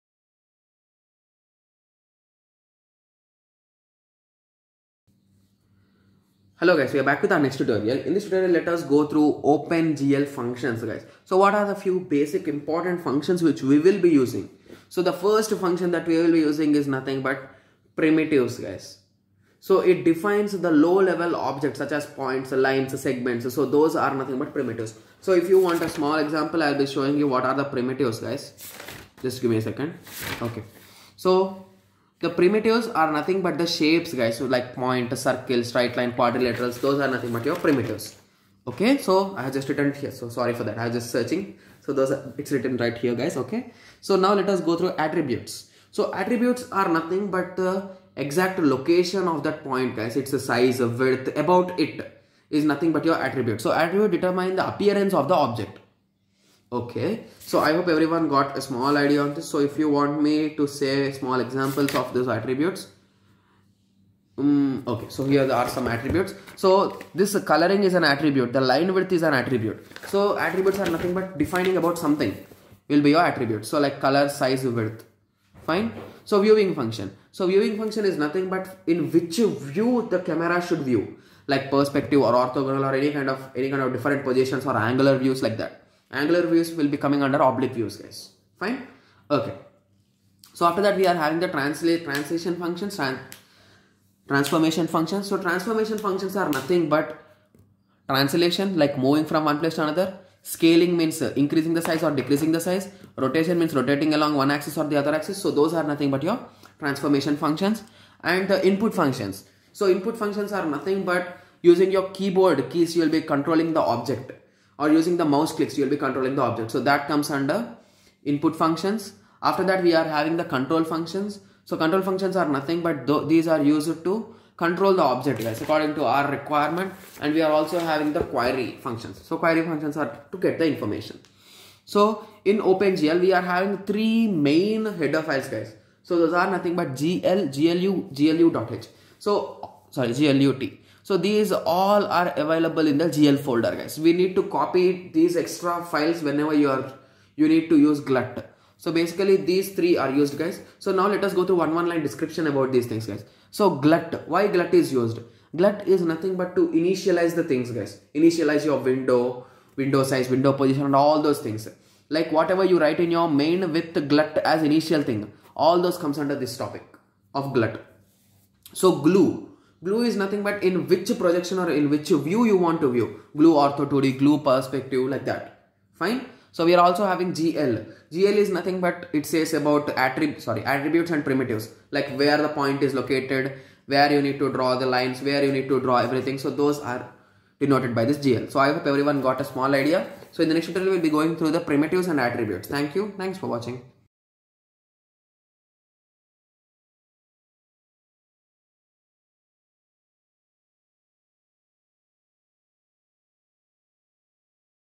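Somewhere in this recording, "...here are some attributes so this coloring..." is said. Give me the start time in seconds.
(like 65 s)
65 s.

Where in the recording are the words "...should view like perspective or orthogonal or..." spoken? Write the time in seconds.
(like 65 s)
80 s.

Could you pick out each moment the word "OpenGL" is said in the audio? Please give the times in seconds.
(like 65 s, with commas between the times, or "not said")
9 s, 132 s.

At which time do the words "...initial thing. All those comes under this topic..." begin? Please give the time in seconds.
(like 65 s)
164 s.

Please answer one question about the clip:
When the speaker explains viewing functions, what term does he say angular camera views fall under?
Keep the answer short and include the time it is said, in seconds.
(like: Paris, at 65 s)
Oblique views, at 87 s.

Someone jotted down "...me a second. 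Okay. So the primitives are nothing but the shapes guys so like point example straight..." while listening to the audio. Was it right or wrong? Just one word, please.
wrong.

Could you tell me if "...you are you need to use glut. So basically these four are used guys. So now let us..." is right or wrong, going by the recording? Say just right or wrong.
wrong.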